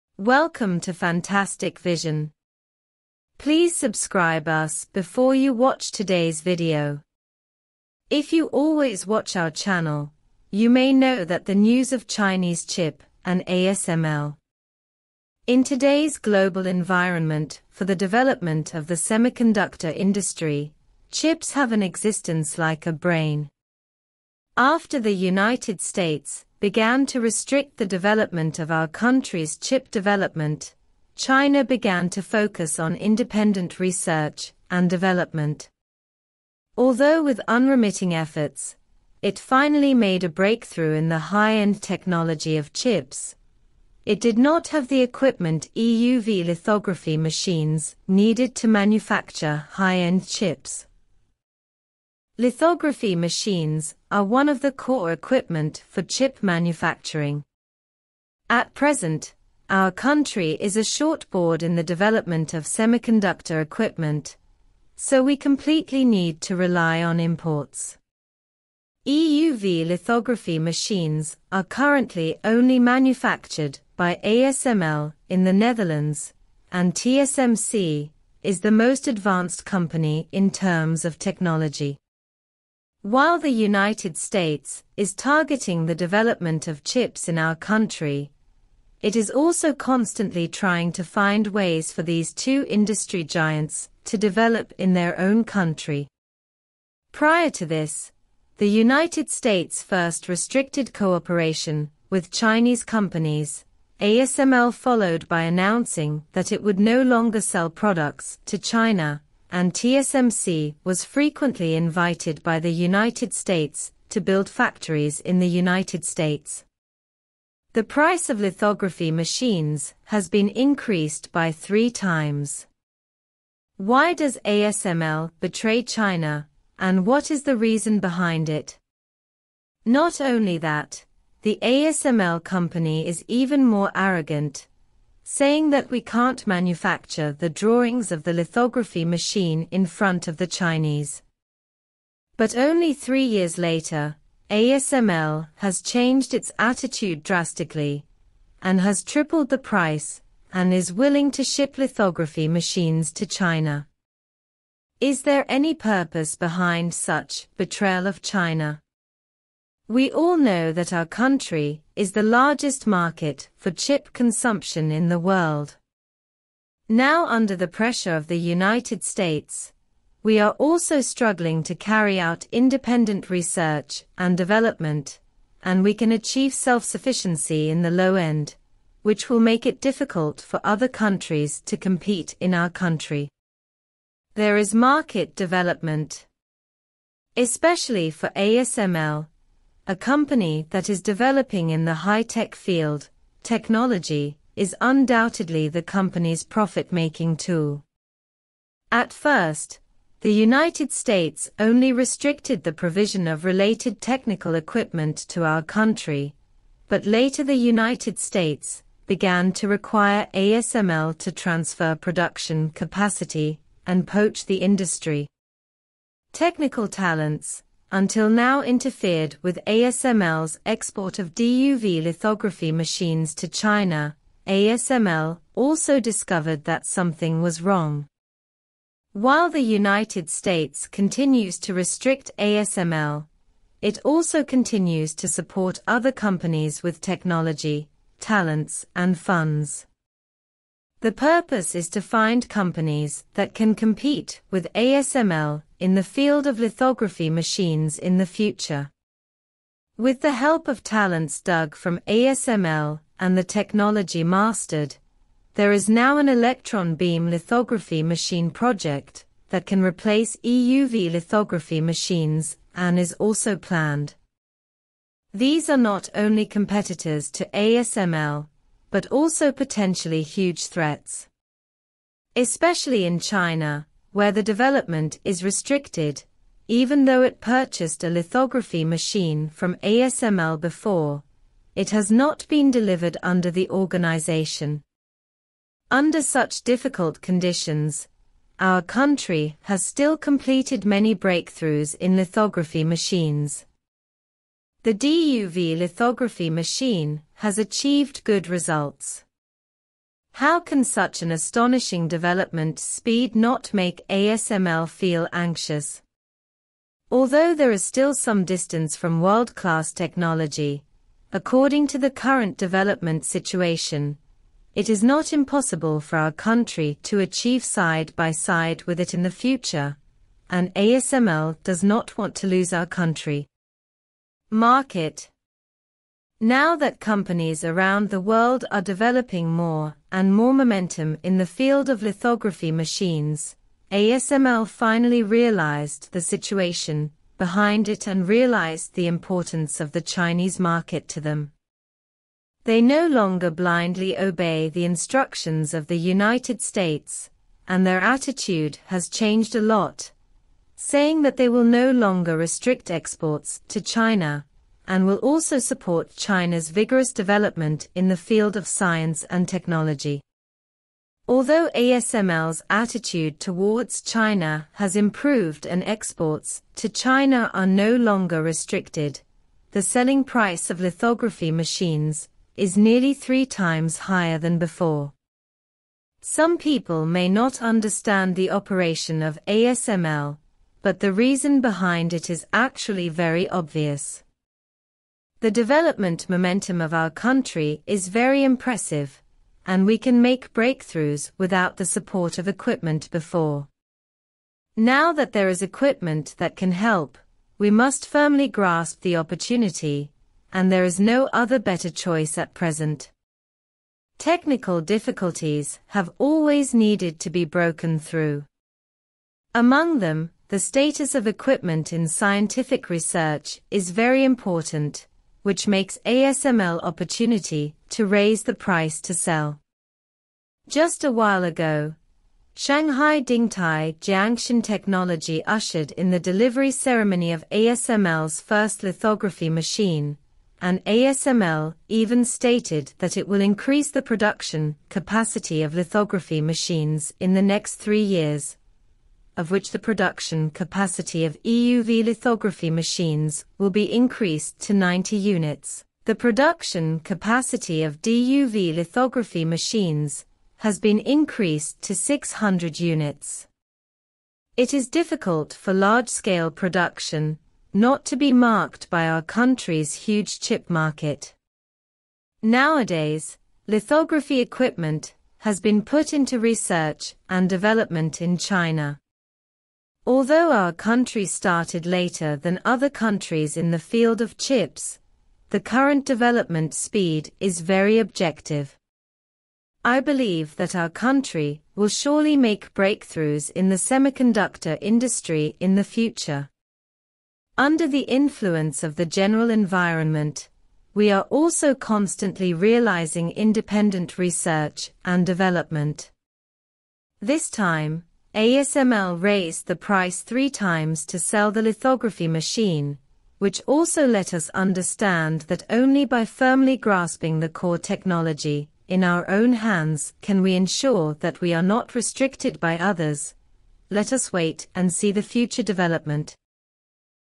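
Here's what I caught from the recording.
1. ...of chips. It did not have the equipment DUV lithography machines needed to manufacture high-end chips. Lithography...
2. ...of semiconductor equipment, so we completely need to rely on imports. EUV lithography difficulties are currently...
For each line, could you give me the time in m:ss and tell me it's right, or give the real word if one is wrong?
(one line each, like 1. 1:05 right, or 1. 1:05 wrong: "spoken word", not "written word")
1. 0:42 wrong: "EUV", not "DUV"
2. 1:02 wrong: "machines", not "difficulties".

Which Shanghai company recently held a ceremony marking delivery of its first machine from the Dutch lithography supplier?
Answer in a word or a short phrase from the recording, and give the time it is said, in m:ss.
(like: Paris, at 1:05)
Shanghai Dingtai Jiangshan Technology, at 7:02.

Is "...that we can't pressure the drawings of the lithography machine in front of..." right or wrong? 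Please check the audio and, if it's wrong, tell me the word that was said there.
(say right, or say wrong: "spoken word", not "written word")
wrong: "manufacture", not "pressure".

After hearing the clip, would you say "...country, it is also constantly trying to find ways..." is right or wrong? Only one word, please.
right.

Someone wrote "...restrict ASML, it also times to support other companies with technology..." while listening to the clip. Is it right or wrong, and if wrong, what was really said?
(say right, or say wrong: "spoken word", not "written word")
wrong: "continues", not "times".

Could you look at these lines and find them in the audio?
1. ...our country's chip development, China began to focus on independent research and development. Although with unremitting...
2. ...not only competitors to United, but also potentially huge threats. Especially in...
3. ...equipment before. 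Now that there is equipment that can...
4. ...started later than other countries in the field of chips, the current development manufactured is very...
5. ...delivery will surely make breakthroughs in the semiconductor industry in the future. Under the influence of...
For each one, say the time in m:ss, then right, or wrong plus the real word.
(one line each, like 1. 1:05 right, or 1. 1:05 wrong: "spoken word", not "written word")
1. 0:28 right
2. 4:25 wrong: "ASML", not "United"
3. 6:32 right
4. 7:51 wrong: "speed", not "manufactured"
5. 8:00 wrong: "country", not "delivery".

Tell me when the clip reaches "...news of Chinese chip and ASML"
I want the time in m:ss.
0:11.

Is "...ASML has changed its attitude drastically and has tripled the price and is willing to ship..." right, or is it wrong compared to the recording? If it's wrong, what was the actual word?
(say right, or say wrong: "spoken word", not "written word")
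right.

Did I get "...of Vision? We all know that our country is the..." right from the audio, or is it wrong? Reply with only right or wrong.
wrong.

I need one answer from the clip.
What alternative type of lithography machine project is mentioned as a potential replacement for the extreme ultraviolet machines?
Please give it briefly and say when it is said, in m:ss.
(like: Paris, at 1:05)
electron beam lithography machine, at 4:16.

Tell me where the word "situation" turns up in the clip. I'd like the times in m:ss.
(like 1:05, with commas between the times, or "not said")
5:13, 5:36.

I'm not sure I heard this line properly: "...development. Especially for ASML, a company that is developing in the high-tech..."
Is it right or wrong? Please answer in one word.
right.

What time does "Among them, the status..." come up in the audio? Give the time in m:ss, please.
6:49.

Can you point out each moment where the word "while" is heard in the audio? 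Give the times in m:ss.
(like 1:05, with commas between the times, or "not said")
1:23, 3:49, 7:01.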